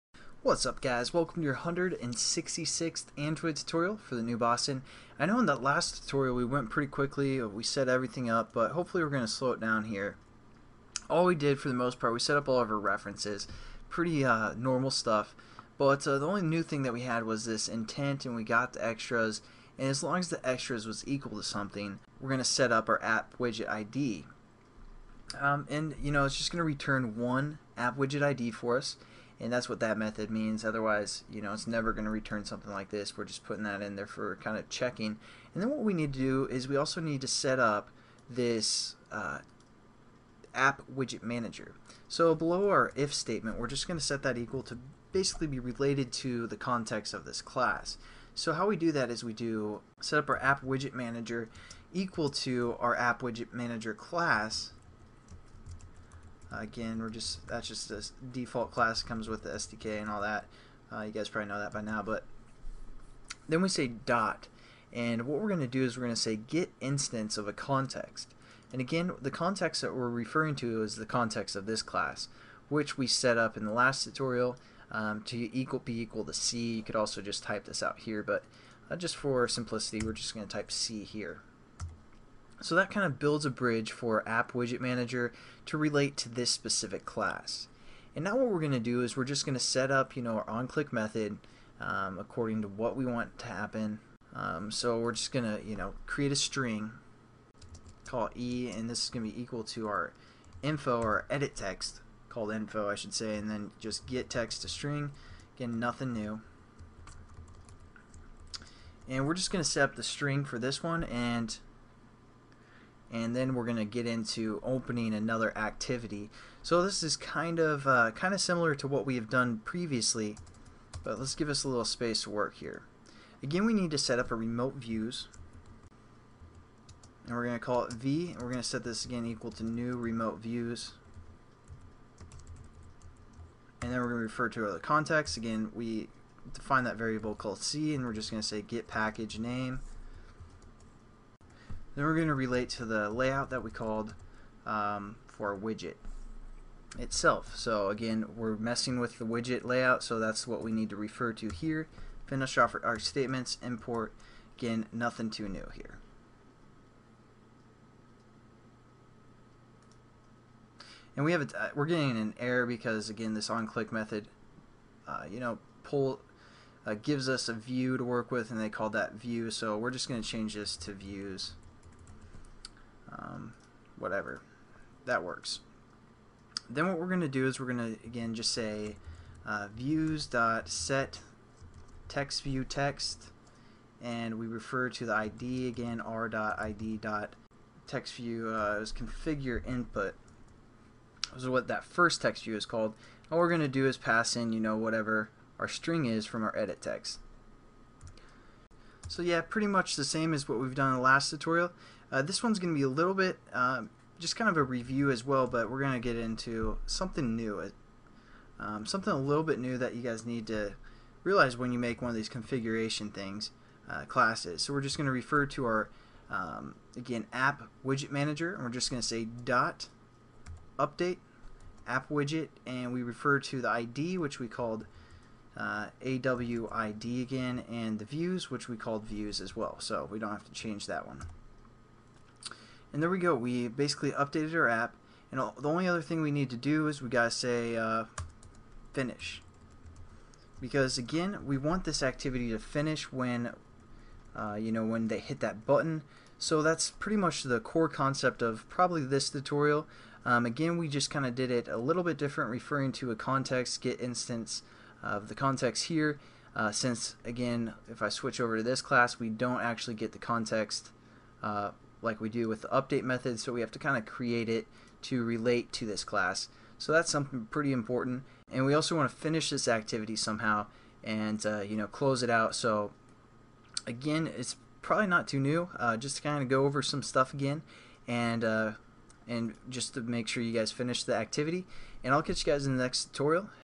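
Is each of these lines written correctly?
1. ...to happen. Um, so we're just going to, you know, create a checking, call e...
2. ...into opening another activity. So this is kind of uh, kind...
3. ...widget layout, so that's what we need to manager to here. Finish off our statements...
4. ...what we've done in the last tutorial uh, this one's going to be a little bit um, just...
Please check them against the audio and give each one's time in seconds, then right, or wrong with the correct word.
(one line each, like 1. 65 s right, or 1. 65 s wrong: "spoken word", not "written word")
1. 93 s wrong: "string", not "checking"
2. 114 s right
3. 149 s wrong: "refer", not "manager"
4. 200 s right.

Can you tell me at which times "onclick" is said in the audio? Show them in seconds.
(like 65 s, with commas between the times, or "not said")
90 s, 163 s.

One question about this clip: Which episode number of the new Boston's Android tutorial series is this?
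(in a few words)
166th.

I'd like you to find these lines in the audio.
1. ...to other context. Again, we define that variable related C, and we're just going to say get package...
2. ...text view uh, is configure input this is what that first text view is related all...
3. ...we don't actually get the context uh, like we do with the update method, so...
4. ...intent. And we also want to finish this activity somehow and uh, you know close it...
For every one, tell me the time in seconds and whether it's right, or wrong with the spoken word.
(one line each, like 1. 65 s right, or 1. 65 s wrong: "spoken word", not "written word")
1. 134 s wrong: "called", not "related"
2. 187 s wrong: "called", not "related"
3. 259 s right
4. 267 s wrong: "important", not "intent".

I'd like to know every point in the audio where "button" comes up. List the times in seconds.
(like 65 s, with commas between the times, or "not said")
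245 s.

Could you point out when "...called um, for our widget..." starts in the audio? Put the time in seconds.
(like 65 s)
143 s.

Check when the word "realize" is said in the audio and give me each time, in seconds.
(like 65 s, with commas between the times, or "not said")
211 s.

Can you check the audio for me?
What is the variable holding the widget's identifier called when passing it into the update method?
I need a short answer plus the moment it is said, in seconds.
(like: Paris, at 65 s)
AWID, at 226 s.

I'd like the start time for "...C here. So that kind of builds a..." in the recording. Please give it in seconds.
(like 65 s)
80 s.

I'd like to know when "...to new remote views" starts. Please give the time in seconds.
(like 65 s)
129 s.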